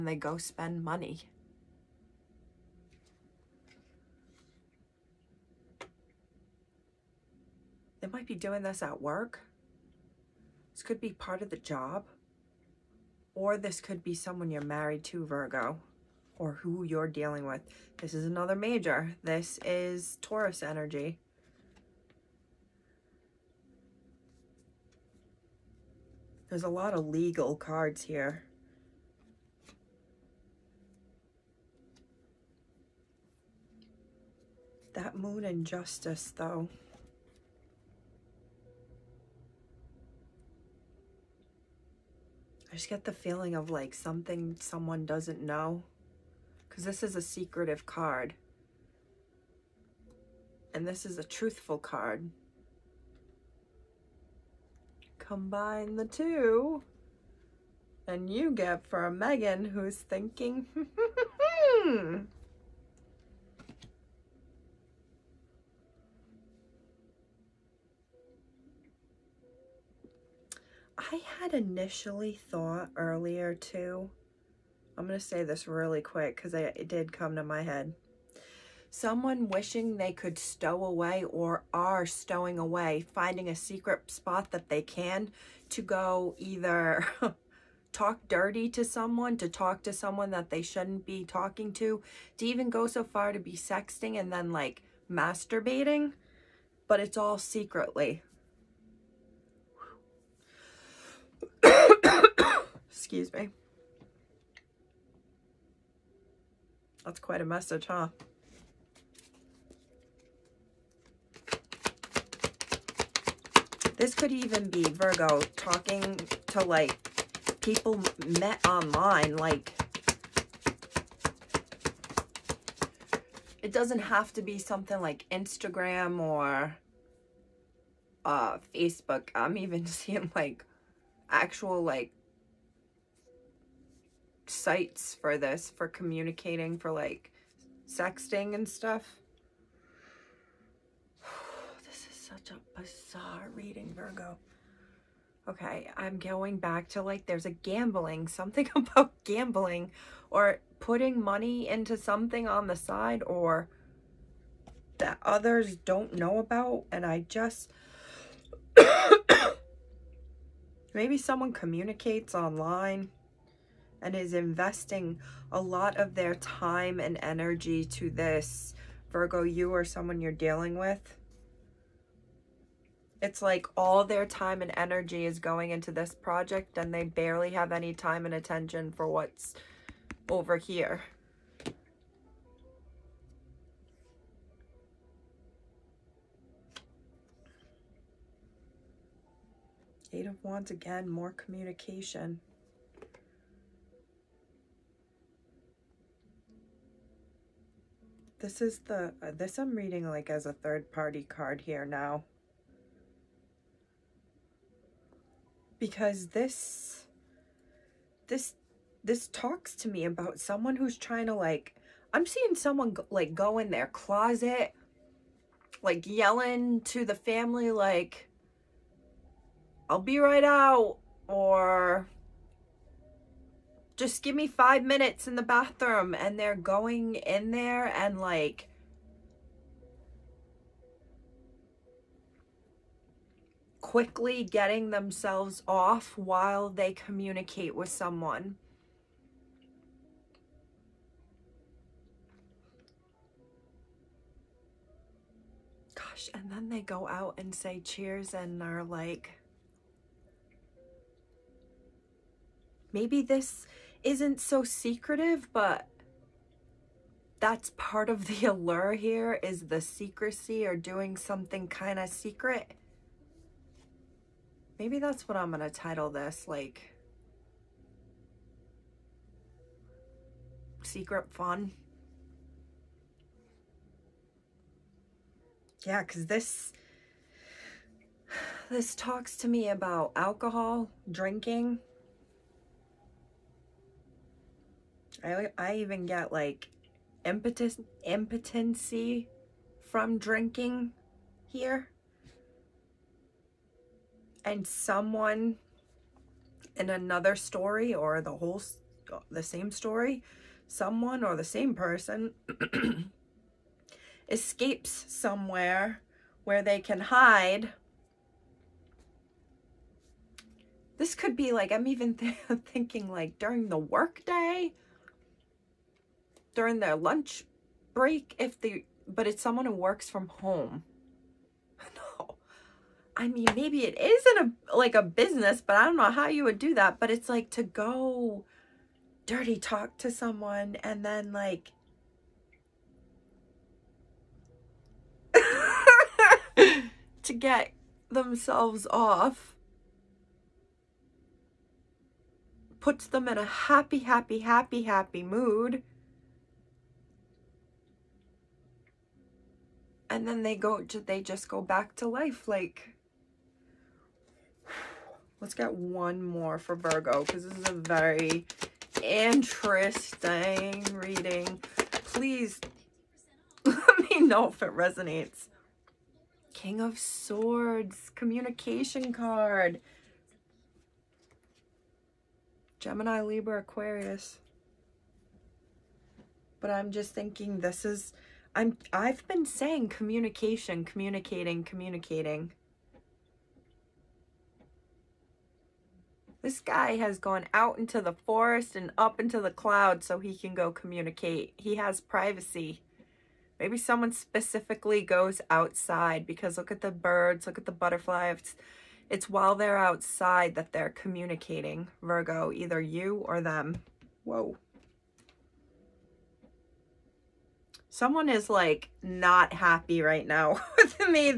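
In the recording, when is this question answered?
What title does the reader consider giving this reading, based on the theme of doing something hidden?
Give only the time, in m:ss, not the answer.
4:30.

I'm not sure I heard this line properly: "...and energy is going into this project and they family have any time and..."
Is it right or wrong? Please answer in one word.
wrong.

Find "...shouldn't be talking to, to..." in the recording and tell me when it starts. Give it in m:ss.
1:30.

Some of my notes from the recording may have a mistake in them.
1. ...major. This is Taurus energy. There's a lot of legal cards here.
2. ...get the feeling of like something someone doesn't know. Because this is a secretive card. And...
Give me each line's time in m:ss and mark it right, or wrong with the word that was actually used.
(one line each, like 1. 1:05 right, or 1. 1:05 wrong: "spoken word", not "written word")
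1. 0:18 right
2. 0:42 right.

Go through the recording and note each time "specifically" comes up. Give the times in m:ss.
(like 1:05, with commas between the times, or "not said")
6:34.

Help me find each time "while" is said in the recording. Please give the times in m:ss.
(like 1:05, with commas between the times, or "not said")
3:56, 6:39.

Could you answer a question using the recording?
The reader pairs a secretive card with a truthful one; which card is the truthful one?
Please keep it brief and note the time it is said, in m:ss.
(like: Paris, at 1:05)
Justice, at 0:35.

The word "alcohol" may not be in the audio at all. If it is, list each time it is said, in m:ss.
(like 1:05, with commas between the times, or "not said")
4:40.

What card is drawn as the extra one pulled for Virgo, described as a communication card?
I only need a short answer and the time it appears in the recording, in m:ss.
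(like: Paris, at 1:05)
King of Swords, at 6:06.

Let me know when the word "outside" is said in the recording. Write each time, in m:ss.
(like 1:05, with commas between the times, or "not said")
6:35, 6:39.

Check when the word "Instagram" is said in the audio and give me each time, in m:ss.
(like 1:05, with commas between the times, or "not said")
2:05.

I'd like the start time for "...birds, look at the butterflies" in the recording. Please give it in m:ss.
6:36.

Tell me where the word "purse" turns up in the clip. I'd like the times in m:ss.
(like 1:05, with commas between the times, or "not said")
not said.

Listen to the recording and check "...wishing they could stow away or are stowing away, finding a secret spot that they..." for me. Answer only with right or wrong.
right.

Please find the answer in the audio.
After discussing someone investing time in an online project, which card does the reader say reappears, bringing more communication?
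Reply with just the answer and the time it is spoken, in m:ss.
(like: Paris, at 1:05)
Eight of Wands, at 3:10.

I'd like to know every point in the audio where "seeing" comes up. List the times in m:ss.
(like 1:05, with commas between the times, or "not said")
2:09, 3:32.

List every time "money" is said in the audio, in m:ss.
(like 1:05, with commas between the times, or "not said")
0:00, 2:31.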